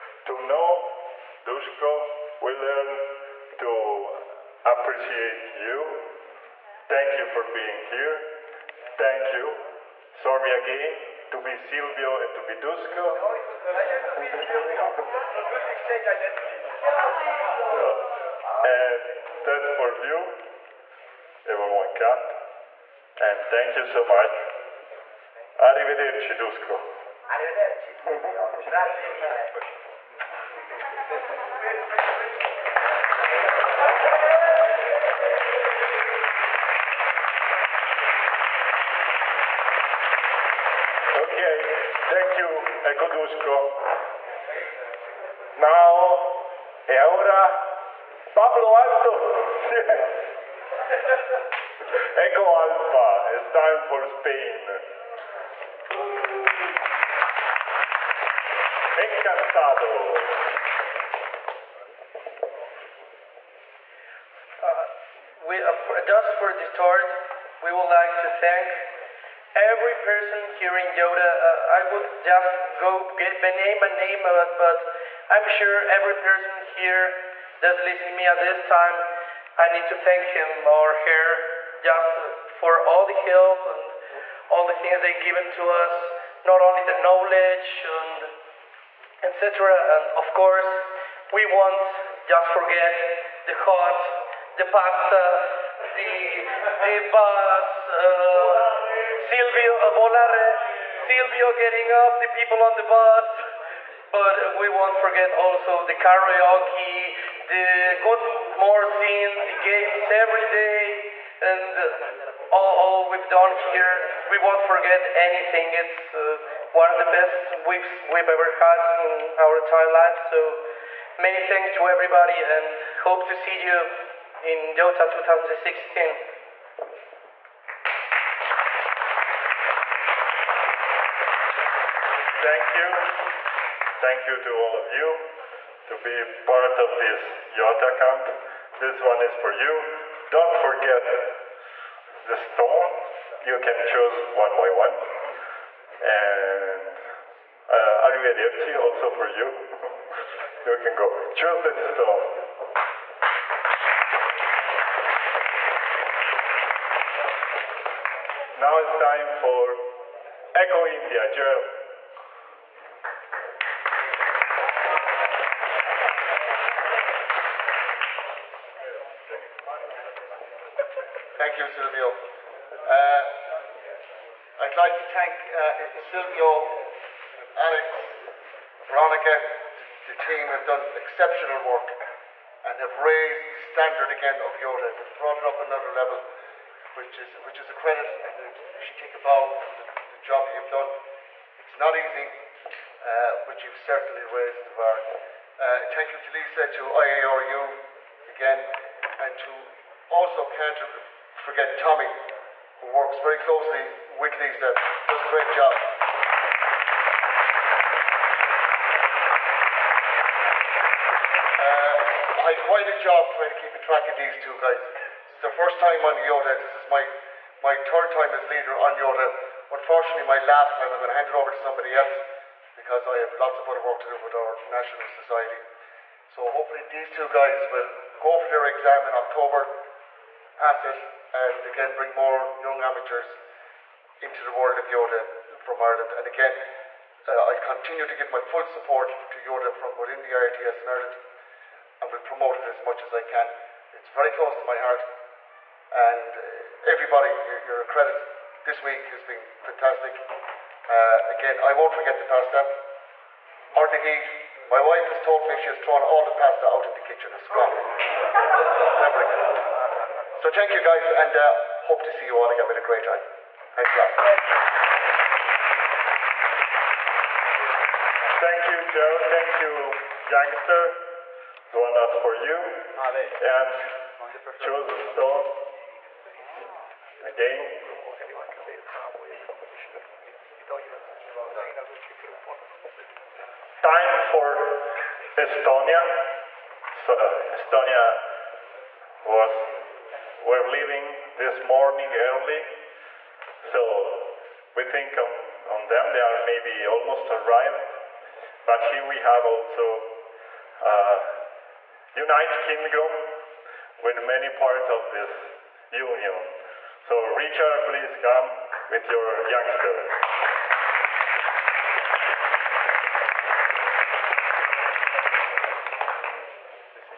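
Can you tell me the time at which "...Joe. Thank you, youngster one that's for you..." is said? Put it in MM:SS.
04:28.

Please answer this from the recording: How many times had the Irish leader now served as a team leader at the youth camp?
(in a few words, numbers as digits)
3.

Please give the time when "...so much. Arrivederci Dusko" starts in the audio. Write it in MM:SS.
00:23.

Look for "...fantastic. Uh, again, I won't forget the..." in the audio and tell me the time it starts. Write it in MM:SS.
04:09.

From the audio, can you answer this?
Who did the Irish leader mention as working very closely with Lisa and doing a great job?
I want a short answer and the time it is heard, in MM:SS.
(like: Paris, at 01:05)
Tommy, at 03:21.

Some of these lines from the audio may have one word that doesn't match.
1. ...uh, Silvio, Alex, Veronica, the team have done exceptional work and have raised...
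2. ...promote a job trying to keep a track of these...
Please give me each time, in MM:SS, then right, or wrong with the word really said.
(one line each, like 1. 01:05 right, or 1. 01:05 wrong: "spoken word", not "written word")
1. 02:55 right
2. 03:32 wrong: "quite", not "promote".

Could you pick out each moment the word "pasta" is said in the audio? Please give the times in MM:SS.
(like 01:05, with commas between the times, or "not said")
01:34, 04:12, 04:16.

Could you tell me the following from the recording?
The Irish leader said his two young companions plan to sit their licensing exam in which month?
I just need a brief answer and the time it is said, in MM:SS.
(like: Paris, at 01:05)
October, at 03:49.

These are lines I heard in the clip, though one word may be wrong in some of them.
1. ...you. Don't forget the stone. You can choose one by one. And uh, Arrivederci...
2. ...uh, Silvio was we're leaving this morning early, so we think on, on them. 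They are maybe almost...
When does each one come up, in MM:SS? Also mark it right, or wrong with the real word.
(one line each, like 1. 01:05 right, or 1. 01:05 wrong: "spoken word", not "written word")
1. 02:19 right
2. 04:47 wrong: "Estonia", not "Silvio".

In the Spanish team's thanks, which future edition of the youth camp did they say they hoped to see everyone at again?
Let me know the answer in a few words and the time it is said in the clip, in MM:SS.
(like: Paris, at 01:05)
Yota 2016, at 02:04.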